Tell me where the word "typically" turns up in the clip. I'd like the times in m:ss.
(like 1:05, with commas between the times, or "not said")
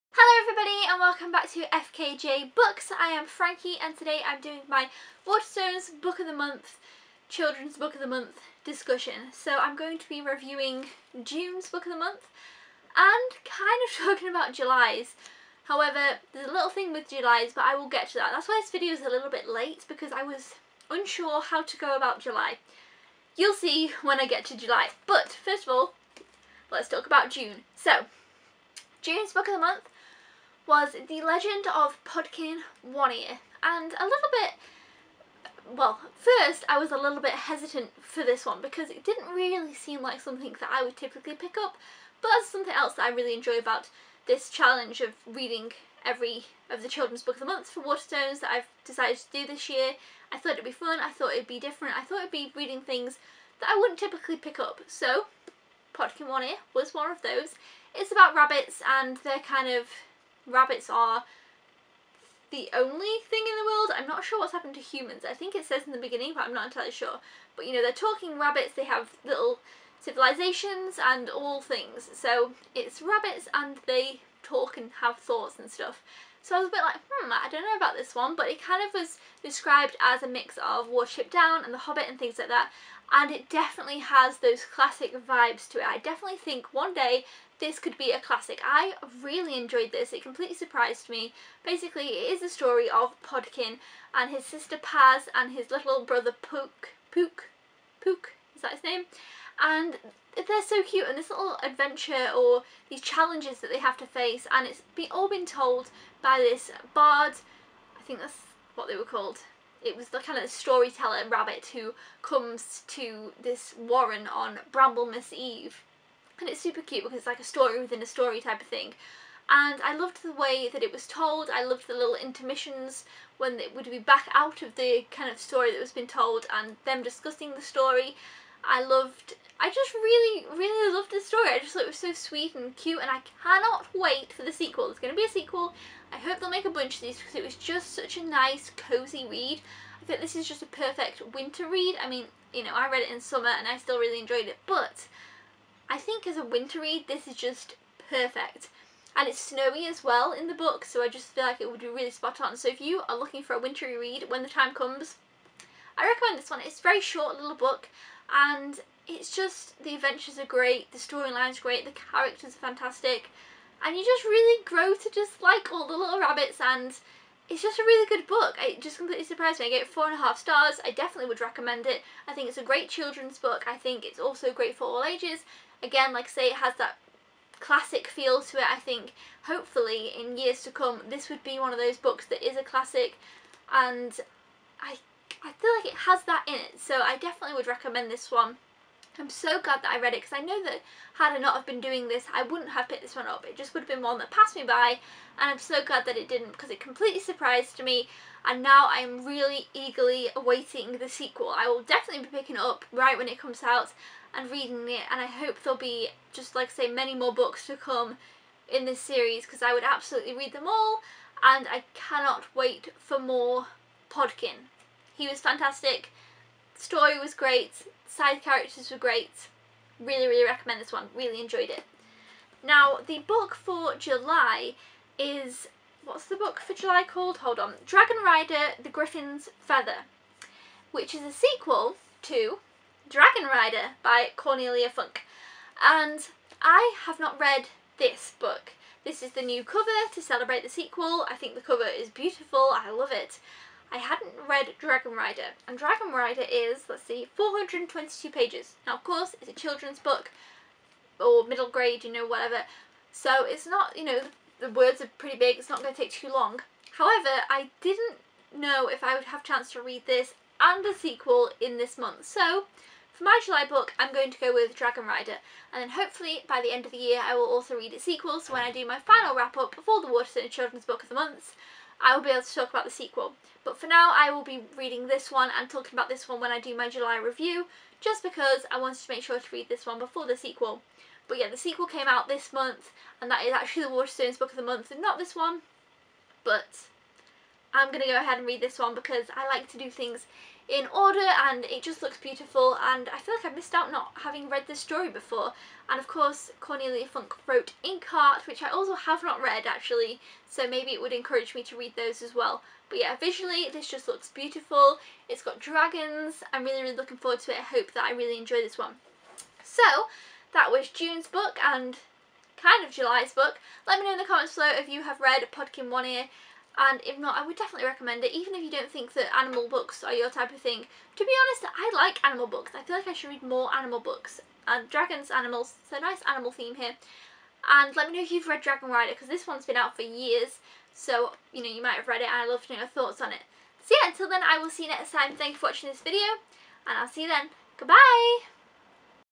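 0:40, 0:53.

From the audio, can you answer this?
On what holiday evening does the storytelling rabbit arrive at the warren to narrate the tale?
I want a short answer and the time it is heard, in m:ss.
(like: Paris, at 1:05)
Bramblemas Eve, at 1:54.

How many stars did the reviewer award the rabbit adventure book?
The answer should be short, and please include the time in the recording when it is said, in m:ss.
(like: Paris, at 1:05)
4.5, at 2:49.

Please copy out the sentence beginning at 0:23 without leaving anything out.
You'll see when I get to July.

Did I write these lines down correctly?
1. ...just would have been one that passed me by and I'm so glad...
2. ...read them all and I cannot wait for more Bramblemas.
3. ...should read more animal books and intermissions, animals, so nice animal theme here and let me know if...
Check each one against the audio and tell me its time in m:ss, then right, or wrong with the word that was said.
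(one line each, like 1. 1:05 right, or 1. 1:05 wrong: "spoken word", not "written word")
1. 3:13 right
2. 3:30 wrong: "Podkin", not "Bramblemas"
3. 5:23 wrong: "dragons", not "intermissions".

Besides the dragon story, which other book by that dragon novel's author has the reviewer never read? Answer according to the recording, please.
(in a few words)
Inkheart.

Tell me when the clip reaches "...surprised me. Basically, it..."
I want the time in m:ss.
1:30.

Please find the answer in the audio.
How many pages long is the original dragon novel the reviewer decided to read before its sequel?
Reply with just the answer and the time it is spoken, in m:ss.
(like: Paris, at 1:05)
422, at 4:07.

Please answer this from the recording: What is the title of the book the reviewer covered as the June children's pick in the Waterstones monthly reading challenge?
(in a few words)
The Legend of Podkin One Ear.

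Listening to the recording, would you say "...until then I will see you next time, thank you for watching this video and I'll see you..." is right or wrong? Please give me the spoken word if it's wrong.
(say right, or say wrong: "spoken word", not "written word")
right.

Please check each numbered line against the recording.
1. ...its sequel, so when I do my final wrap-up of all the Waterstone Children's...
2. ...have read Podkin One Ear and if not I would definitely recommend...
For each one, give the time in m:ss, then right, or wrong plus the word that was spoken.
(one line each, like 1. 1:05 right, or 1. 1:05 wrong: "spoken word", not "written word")
1. 4:27 right
2. 5:15 right.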